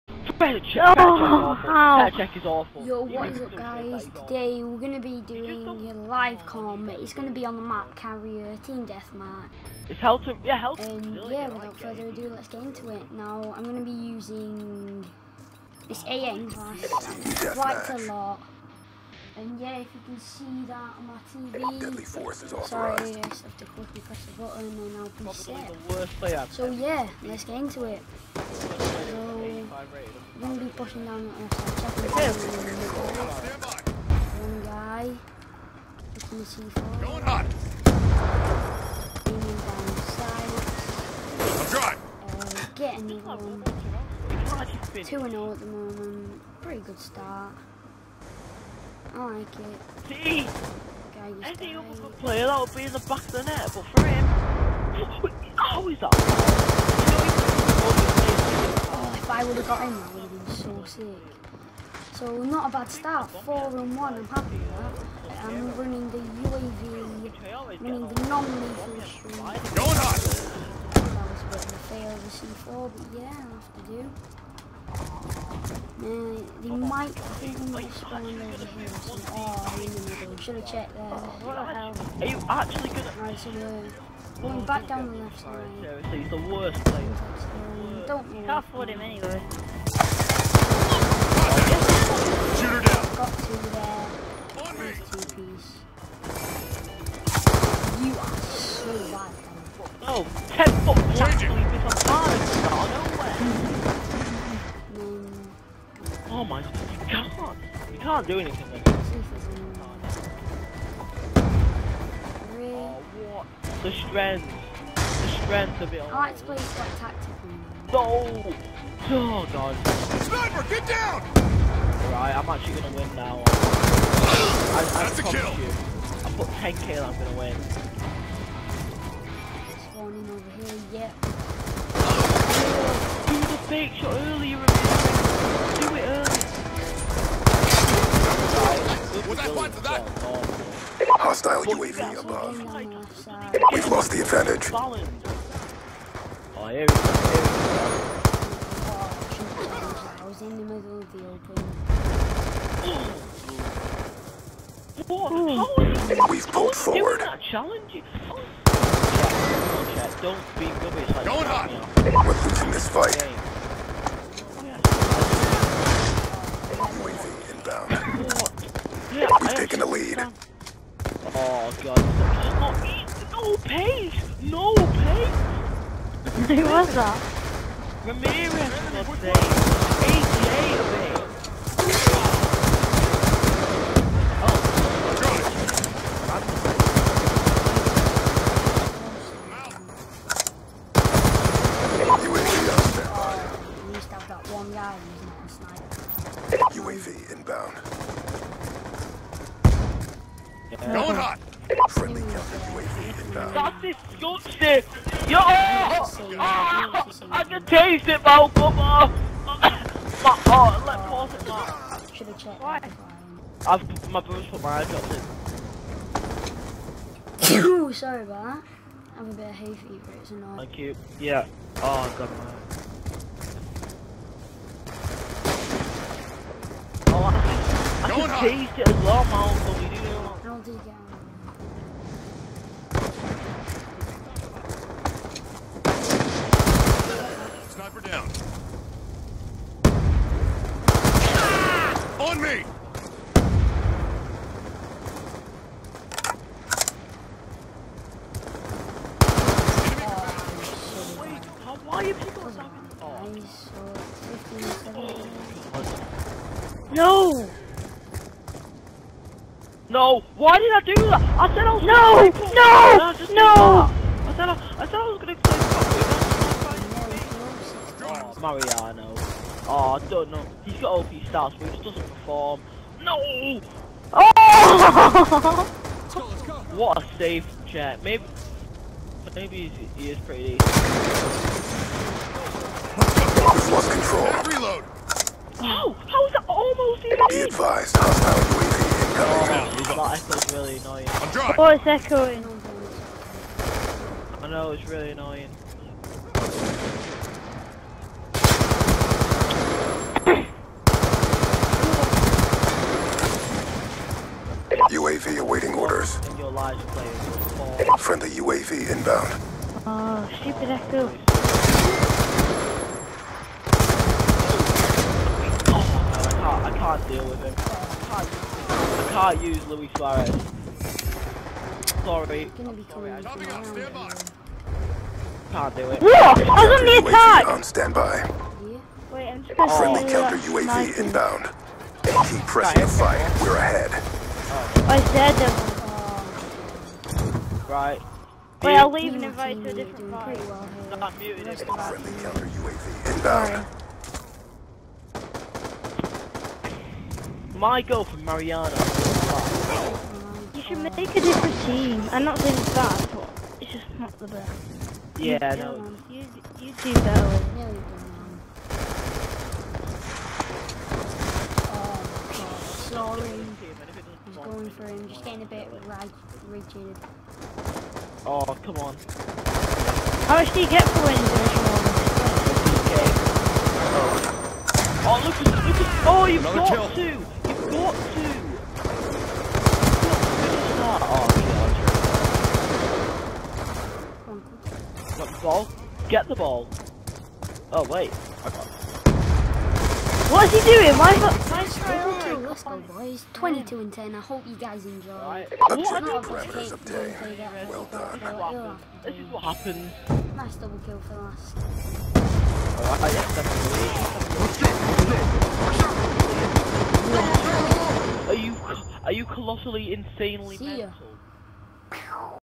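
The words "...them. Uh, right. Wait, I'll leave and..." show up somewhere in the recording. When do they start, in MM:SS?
05:37.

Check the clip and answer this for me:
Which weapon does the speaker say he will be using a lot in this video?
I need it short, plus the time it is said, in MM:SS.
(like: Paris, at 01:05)
AN, at 00:16.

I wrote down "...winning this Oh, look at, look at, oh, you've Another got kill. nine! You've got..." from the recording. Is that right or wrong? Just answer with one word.
wrong.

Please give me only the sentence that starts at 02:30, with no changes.
I was in the middle of the open.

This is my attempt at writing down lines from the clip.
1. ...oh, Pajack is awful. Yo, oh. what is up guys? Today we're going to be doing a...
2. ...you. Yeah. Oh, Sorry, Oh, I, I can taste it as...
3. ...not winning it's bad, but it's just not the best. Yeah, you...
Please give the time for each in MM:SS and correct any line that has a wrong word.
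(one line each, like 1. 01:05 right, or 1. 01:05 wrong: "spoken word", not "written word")
1. 00:00 right
2. 03:40 wrong: "God", not "Sorry"
3. 05:52 wrong: "saying", not "winning".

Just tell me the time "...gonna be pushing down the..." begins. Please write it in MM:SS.
00:30.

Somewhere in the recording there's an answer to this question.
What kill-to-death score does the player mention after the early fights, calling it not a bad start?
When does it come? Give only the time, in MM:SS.
01:03.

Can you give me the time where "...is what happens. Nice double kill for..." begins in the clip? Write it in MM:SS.
06:39.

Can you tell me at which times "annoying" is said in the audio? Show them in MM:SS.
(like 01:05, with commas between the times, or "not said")
03:40, 04:55.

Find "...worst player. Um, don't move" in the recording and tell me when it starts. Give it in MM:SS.
01:26.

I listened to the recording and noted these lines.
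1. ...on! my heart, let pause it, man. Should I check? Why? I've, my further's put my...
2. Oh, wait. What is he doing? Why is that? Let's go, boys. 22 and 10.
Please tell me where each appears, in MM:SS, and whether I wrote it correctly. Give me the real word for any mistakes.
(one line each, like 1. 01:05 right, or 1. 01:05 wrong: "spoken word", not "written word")
1. 03:28 wrong: "brother", not "further"
2. 06:27 right.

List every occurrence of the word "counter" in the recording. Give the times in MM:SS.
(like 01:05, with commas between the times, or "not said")
05:30, 05:42.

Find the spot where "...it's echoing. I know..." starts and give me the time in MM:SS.
04:51.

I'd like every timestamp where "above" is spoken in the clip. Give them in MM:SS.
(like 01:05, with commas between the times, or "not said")
02:22.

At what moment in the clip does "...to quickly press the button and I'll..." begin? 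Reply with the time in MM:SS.
00:23.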